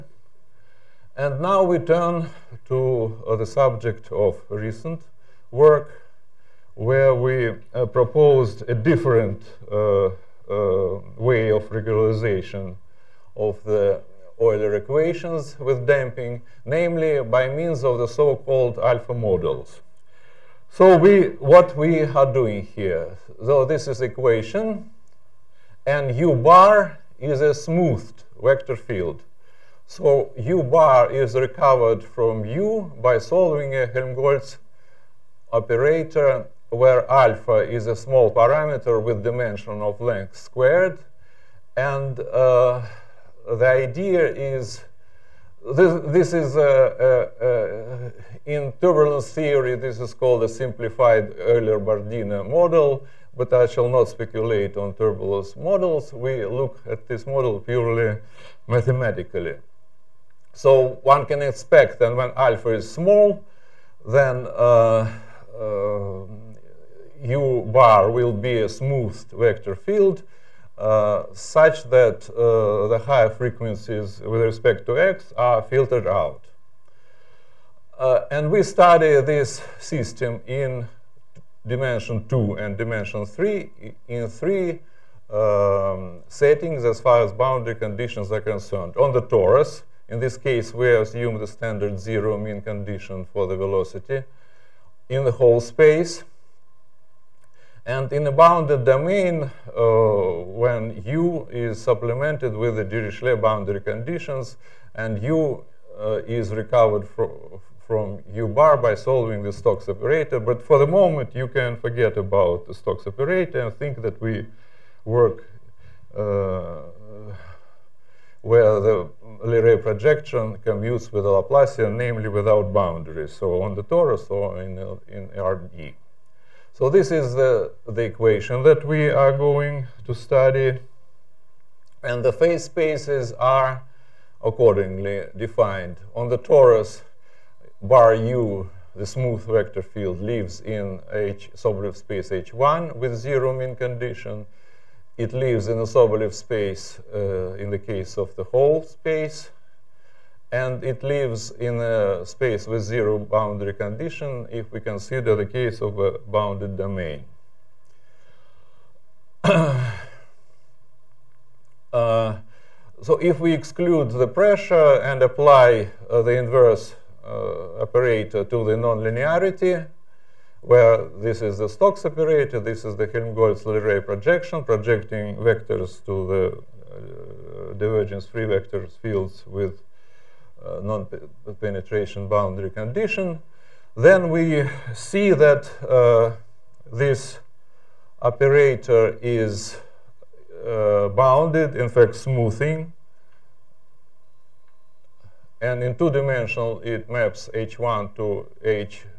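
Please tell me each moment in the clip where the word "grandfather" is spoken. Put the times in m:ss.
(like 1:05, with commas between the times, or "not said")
not said.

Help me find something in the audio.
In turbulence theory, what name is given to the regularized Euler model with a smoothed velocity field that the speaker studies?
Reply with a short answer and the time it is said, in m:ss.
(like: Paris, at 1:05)
simplified Euler-Bardina model, at 0:50.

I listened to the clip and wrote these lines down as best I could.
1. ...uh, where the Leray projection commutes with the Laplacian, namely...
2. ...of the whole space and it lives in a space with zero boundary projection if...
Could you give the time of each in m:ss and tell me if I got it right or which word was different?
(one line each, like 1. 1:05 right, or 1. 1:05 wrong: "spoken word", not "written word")
1. 1:56 right
2. 2:28 wrong: "condition", not "projection".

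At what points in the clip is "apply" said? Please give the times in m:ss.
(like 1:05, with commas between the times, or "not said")
2:45.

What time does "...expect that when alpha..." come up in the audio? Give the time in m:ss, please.
1:01.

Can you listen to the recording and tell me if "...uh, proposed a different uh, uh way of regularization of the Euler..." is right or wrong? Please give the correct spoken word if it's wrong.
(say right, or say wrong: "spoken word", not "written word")
right.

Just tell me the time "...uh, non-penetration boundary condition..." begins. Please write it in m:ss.
3:00.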